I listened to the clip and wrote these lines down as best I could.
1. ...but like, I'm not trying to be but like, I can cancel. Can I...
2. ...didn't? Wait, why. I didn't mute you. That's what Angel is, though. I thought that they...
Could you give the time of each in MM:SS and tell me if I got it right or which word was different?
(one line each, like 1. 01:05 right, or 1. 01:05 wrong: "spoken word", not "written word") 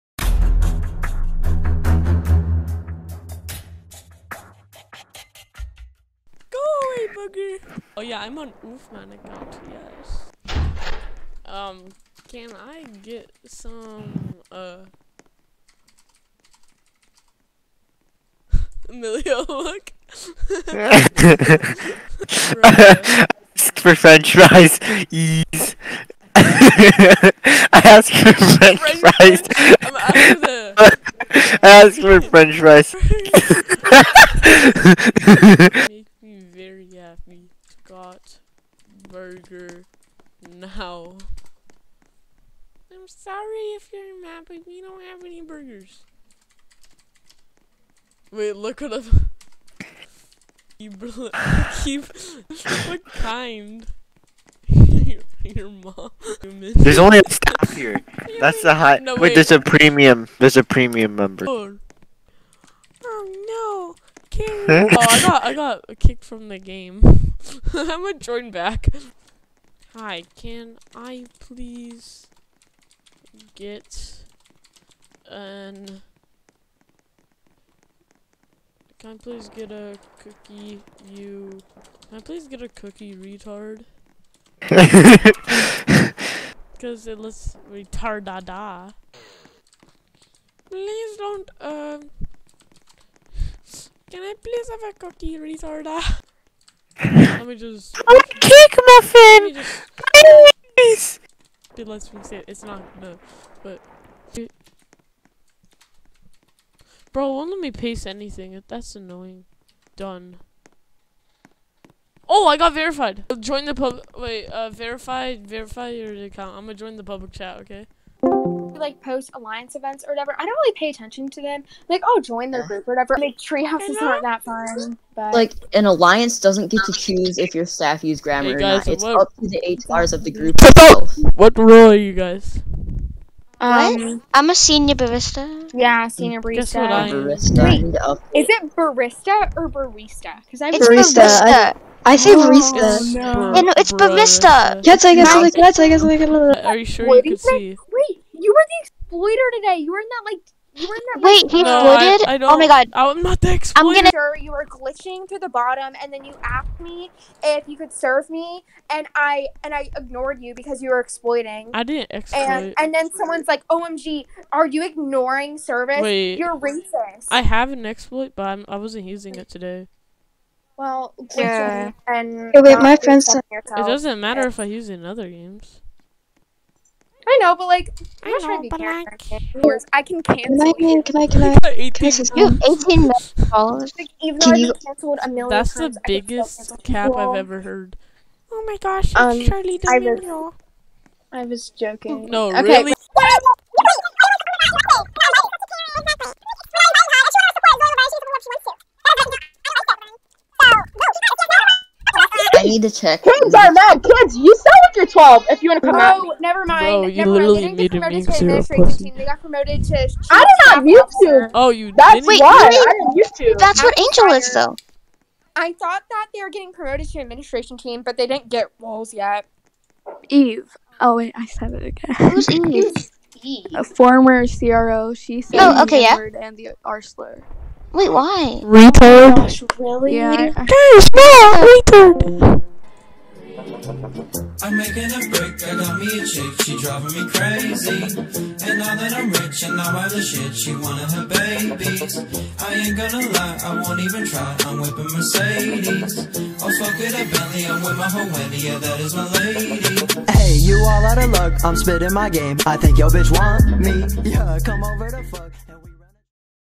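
1. 02:57 right
2. 03:32 right.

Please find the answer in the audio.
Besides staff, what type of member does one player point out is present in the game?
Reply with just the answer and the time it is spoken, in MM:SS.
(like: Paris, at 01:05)
Premium member, at 01:00.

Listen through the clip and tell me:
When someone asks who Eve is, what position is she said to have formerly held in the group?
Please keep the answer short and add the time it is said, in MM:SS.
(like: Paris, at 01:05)
CRO, at 03:44.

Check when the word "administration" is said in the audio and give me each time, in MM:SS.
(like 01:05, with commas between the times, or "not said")
03:28, 03:37.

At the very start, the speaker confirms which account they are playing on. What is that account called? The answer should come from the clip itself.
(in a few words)
Oofman.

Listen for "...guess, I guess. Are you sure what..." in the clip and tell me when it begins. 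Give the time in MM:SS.
02:25.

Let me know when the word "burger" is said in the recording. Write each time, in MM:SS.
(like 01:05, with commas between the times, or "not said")
00:39, 00:45.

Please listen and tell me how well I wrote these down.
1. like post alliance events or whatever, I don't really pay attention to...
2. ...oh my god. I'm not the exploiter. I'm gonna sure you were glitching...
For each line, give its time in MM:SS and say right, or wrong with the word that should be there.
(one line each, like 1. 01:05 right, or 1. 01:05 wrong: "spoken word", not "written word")
1. 01:58 right
2. 02:32 right.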